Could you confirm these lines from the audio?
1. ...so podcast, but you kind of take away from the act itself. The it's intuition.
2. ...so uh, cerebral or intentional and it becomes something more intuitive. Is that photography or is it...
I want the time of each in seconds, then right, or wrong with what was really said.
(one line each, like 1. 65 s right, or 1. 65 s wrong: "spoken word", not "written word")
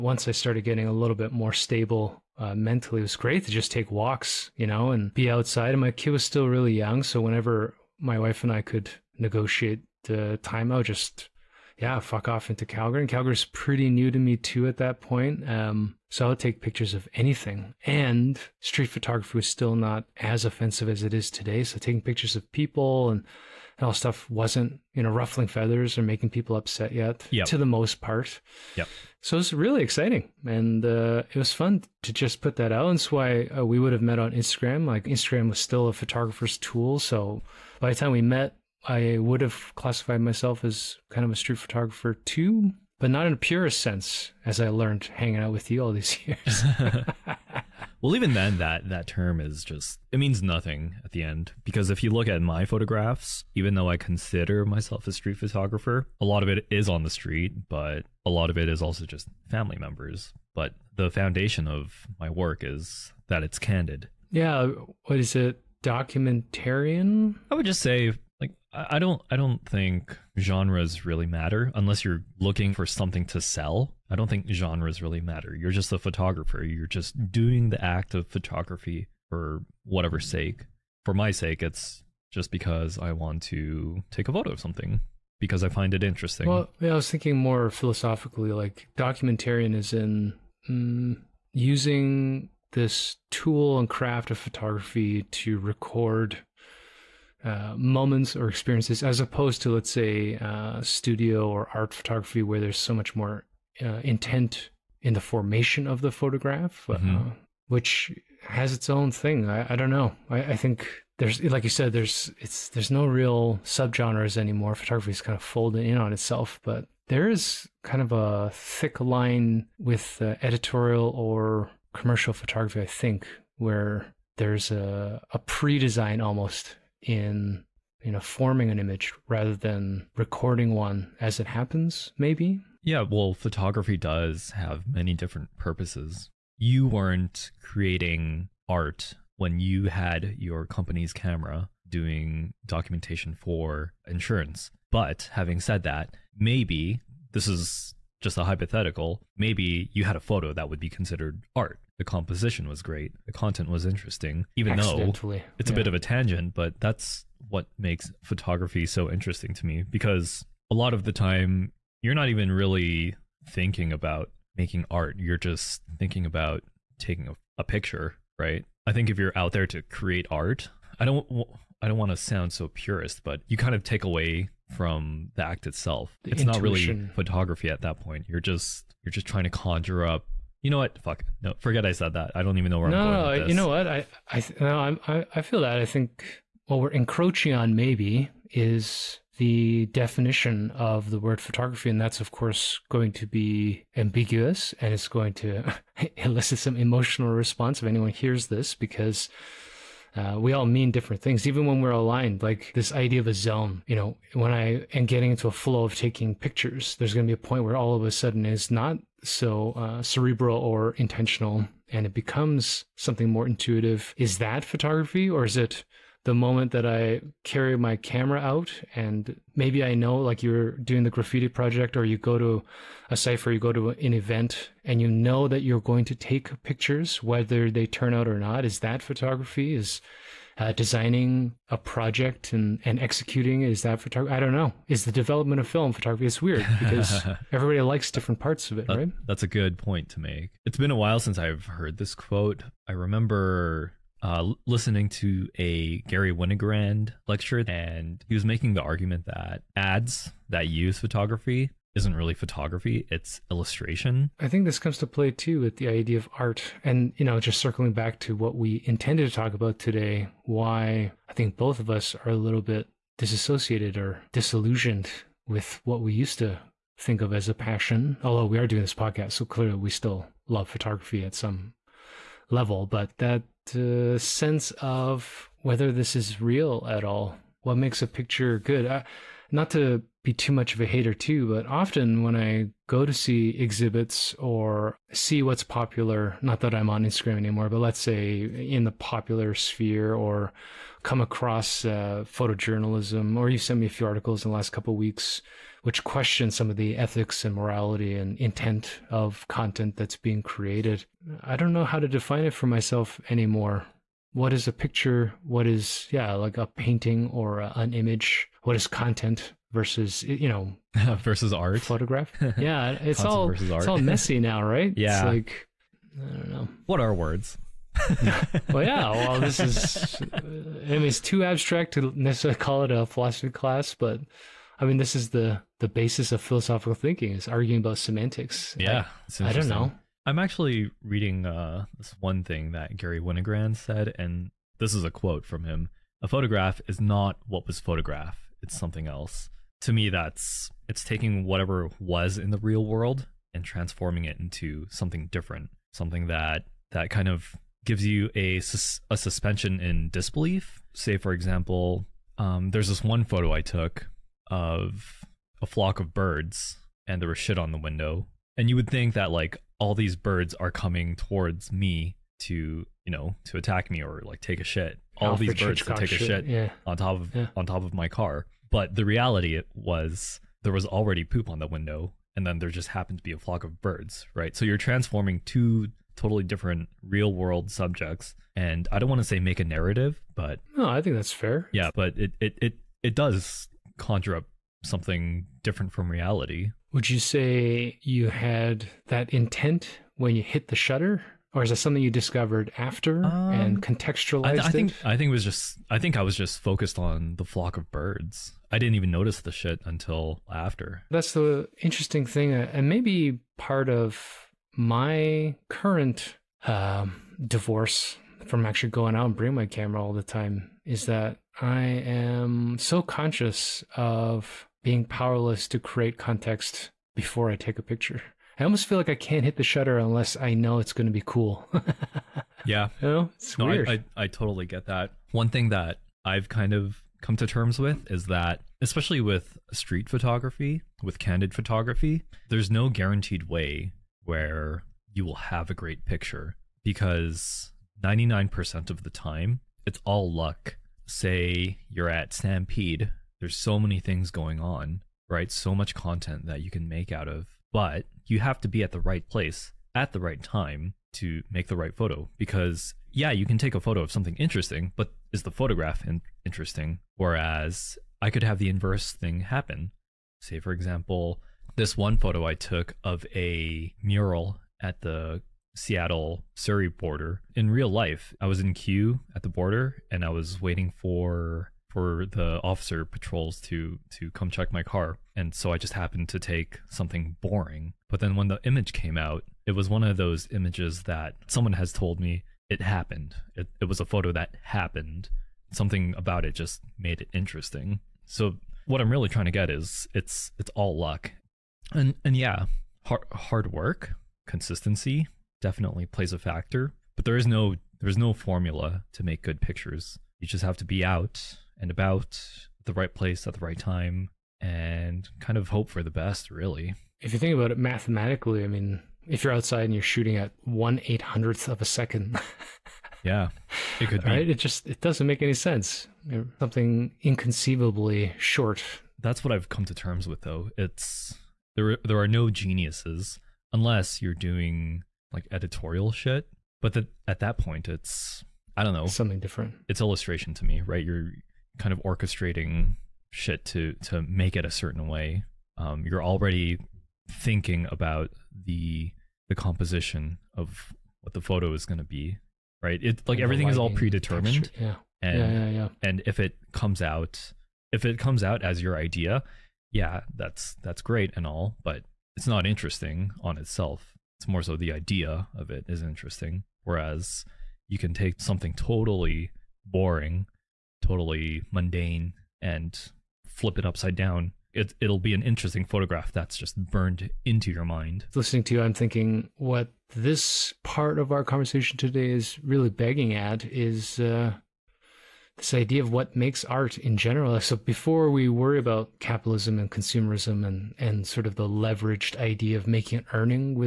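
1. 172 s wrong: "purist", not "podcast"
2. 209 s right.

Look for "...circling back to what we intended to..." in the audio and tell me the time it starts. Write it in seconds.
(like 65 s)
257 s.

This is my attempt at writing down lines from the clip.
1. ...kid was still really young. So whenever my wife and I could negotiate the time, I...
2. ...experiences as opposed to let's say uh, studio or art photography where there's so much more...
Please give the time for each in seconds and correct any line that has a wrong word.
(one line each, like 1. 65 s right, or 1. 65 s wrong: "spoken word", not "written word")
1. 5 s right
2. 98 s right.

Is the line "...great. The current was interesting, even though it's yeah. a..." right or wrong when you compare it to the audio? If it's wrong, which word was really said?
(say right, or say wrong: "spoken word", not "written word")
wrong: "content", not "current".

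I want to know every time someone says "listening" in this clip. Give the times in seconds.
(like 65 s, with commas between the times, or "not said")
244 s, 568 s.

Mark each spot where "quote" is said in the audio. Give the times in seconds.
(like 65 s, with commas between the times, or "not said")
242 s, 335 s.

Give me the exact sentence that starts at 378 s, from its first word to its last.
And I don't want to say make a narrative, but No, I think that's fair.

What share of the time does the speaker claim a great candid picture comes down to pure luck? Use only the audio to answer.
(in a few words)
99%.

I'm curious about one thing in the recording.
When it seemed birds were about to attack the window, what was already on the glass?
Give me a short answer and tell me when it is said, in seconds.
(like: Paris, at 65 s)
Poop, at 371 s.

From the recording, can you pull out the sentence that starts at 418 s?
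I almost feel like I can't hit the shutter unless I know it's going to be cool.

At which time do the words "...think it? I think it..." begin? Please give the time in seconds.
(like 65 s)
394 s.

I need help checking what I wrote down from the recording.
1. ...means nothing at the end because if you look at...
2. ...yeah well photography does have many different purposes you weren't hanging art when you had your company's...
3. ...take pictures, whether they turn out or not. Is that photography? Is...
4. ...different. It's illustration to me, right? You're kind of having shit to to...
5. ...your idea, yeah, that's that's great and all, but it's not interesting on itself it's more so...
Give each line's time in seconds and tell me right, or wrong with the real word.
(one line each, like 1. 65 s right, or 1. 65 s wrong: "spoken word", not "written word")
1. 50 s right
2. 132 s wrong: "creating", not "hanging"
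3. 226 s right
4. 529 s wrong: "orchestrating", not "having"
5. 548 s right.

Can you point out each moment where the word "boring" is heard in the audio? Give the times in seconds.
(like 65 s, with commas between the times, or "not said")
477 s, 559 s.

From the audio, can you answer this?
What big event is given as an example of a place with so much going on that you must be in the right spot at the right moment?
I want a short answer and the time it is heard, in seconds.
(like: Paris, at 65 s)
Stampede, at 442 s.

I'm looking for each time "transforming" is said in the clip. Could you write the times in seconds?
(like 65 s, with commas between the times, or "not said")
343 s, 374 s.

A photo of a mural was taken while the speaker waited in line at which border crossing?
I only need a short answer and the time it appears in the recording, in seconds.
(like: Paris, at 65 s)
Seattle Surrey border, at 465 s.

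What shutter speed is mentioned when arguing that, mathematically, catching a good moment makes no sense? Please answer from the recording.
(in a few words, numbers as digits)
1/800 second.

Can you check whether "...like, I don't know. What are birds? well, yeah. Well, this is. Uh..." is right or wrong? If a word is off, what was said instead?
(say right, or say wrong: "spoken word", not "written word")
wrong: "words", not "birds".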